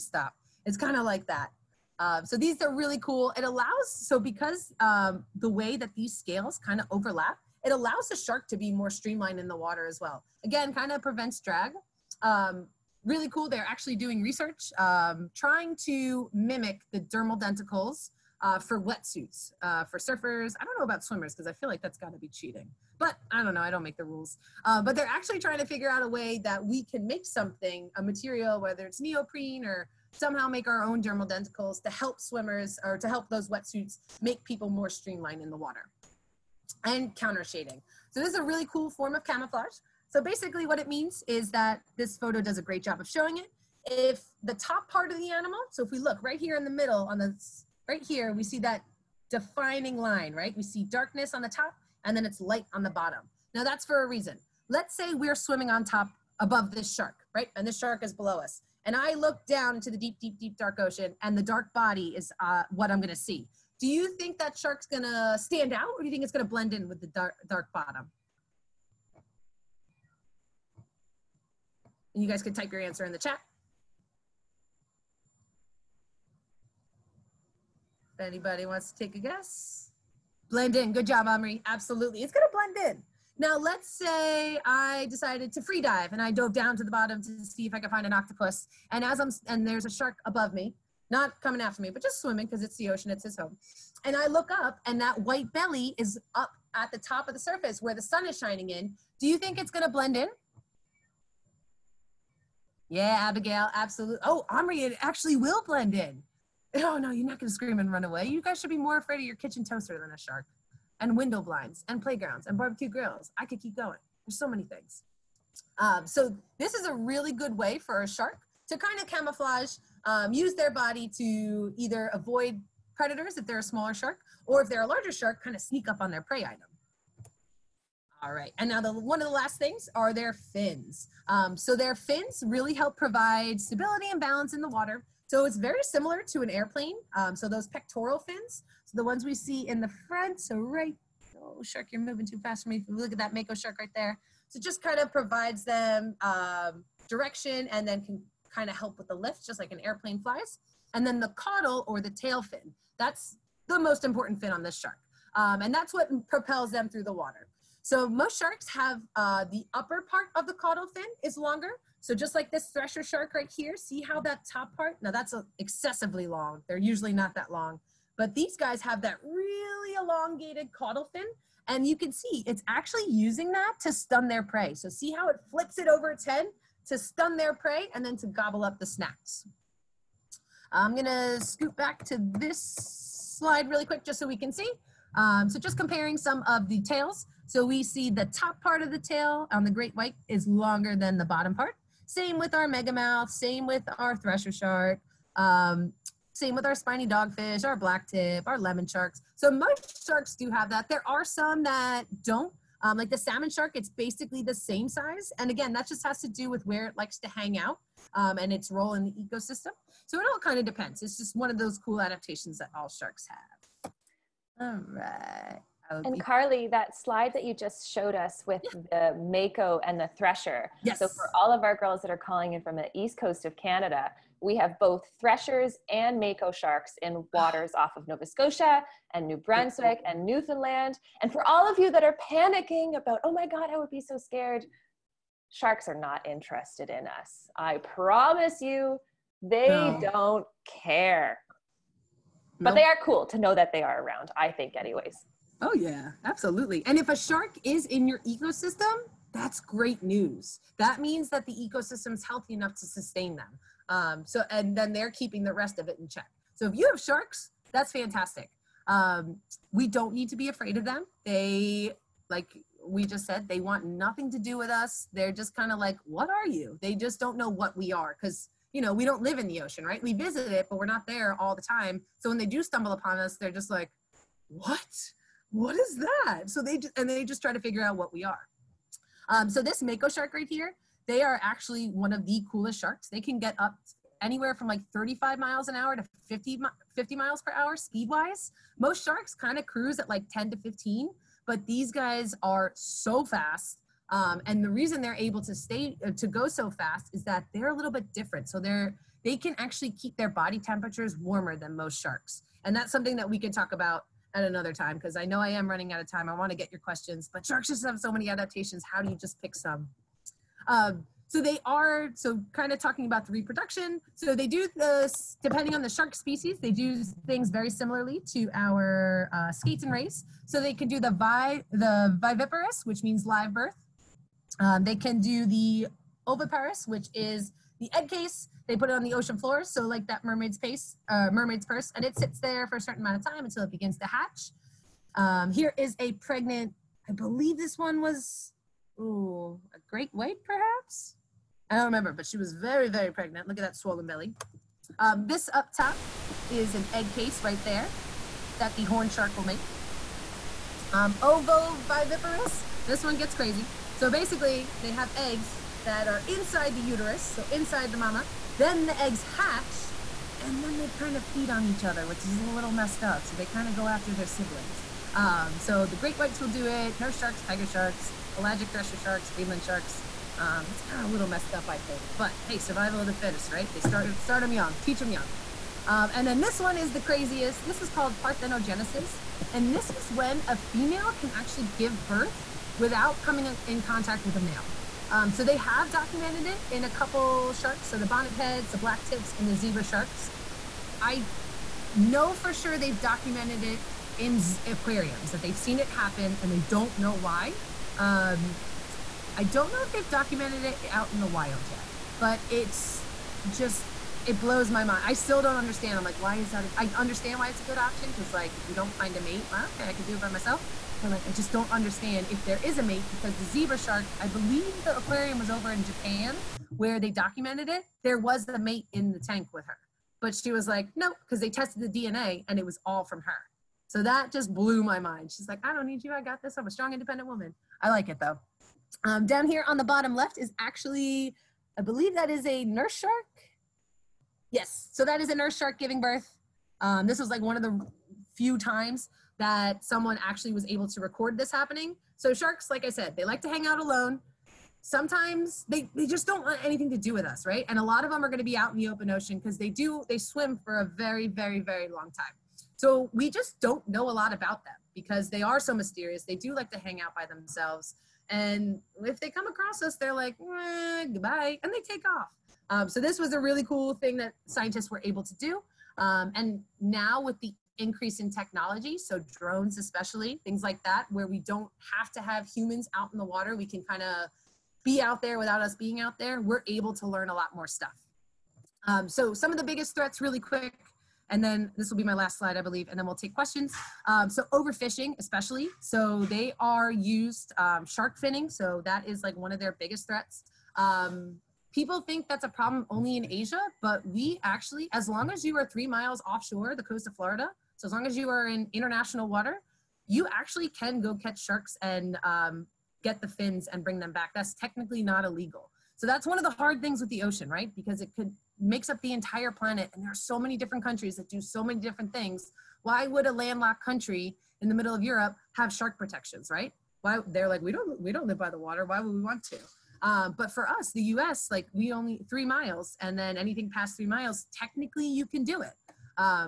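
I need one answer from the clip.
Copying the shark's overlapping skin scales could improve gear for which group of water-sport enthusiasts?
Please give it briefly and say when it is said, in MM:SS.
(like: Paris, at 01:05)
Surfers, at 00:19.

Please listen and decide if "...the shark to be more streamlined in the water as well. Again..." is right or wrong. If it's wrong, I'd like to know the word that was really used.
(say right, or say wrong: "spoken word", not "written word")
right.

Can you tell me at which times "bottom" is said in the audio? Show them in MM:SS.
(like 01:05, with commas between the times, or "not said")
00:52, 01:07, 01:26, 03:11, 07:09.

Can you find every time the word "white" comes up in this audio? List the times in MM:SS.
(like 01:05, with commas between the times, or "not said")
01:35, 03:09, 05:40, 06:06.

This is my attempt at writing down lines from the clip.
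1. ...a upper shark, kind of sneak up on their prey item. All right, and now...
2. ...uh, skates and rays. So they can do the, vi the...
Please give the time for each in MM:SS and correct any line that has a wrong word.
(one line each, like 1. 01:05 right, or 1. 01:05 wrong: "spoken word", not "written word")
1. 02:04 wrong: "larger", not "upper"
2. 05:19 right.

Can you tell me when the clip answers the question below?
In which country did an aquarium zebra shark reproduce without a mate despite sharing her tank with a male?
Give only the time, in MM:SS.
06:55.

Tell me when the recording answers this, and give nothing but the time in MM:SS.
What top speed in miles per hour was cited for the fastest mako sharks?
04:46.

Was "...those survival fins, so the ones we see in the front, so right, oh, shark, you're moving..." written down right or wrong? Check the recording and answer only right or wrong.
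wrong.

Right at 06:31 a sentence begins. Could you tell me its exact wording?
I know for sure they've documented it in aquariums, that they've seen it happen and they don't know why.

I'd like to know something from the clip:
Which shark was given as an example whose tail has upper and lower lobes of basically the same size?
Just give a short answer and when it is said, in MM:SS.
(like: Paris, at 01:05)
Salmon shark, at 03:23.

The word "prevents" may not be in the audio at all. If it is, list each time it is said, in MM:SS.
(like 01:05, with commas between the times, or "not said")
00:11.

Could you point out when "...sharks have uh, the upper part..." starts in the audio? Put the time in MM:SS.
02:38.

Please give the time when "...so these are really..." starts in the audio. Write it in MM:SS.
00:02.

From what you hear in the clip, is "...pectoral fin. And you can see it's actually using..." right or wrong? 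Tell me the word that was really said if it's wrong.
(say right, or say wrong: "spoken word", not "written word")
wrong: "caudal", not "pectoral".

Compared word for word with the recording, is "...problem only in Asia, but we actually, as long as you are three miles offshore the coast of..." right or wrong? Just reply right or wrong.
right.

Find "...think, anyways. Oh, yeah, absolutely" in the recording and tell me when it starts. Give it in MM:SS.
04:04.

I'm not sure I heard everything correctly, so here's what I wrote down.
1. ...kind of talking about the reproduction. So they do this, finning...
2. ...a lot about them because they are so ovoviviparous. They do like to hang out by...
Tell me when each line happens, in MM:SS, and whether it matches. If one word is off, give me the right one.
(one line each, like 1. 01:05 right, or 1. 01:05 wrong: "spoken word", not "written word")
1. 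05:12 wrong: "depending", not "finning"
2. 07:34 wrong: "mysterious", not "ovoviviparous".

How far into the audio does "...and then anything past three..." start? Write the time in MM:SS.
08:42.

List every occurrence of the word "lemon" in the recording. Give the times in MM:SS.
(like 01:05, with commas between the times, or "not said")
03:18.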